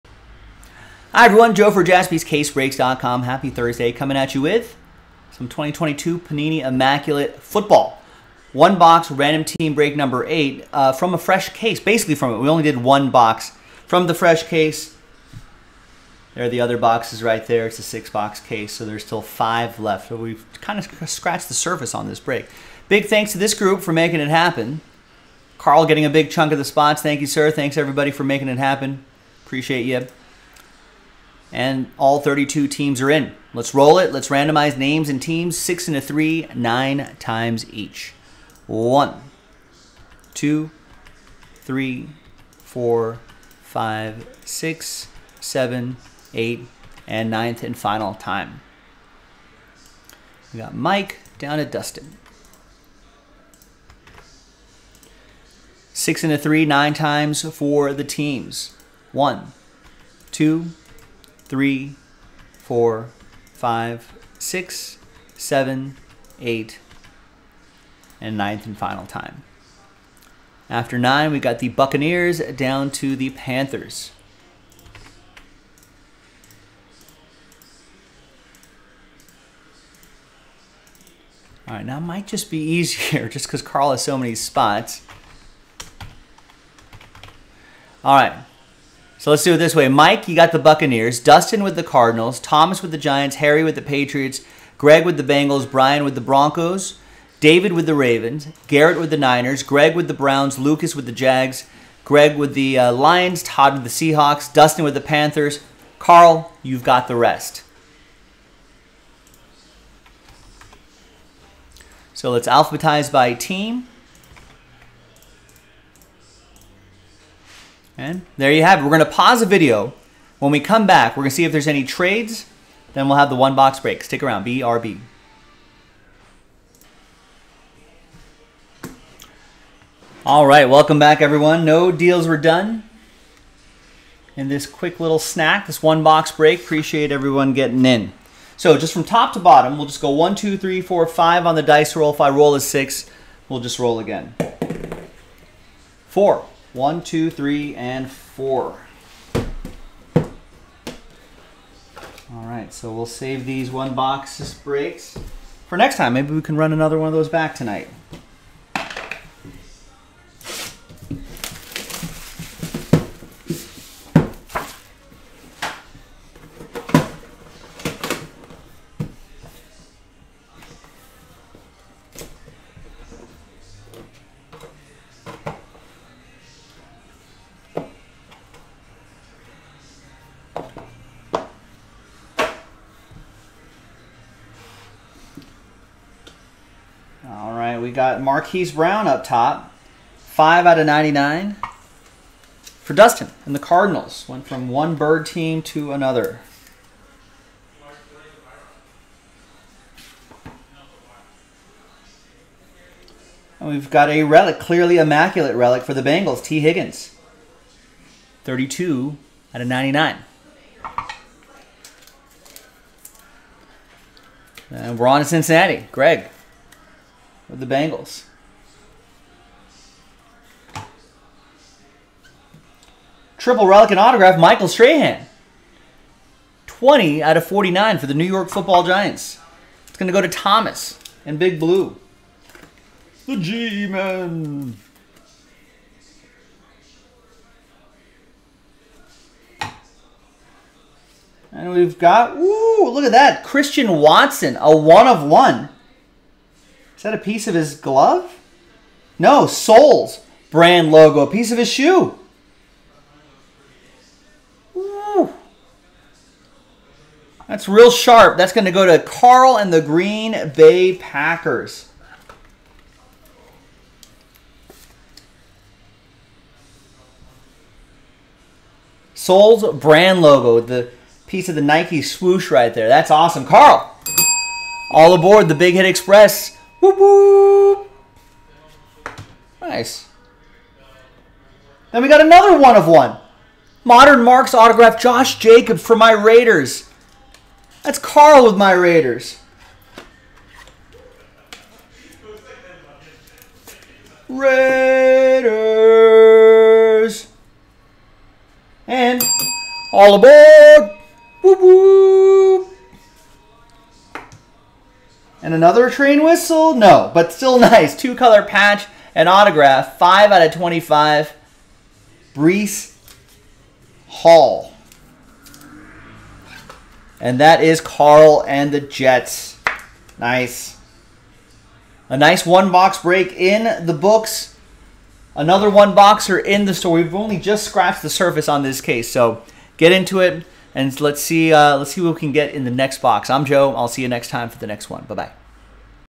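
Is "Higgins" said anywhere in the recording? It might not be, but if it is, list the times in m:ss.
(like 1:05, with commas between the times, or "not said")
3:26.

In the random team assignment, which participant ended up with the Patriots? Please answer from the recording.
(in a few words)
Harry.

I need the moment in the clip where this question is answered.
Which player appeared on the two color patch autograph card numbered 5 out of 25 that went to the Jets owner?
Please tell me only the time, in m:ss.
5:12.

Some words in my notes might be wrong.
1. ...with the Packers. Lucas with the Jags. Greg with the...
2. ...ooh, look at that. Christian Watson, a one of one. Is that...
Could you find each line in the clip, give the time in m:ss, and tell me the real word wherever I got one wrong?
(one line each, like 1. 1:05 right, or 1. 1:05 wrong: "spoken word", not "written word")
1. 1:39 wrong: "Browns", not "Packers"
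2. 4:02 right.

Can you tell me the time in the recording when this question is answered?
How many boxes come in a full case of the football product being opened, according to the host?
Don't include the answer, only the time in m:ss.
0:17.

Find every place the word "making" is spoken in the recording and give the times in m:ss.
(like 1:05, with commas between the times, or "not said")
0:23, 0:28.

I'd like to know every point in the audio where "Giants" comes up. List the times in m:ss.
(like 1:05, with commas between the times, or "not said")
1:32, 3:48.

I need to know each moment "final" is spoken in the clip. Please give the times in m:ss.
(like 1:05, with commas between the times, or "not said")
0:47, 1:08.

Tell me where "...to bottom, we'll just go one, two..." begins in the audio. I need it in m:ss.
2:19.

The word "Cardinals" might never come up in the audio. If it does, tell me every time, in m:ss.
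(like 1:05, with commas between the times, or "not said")
1:31, 3:13.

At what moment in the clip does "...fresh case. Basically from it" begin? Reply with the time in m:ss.
0:11.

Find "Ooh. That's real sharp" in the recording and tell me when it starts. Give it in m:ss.
4:14.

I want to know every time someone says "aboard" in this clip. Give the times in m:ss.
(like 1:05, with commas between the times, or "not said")
4:35, 5:00.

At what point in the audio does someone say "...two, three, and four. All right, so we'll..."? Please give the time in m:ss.
2:27.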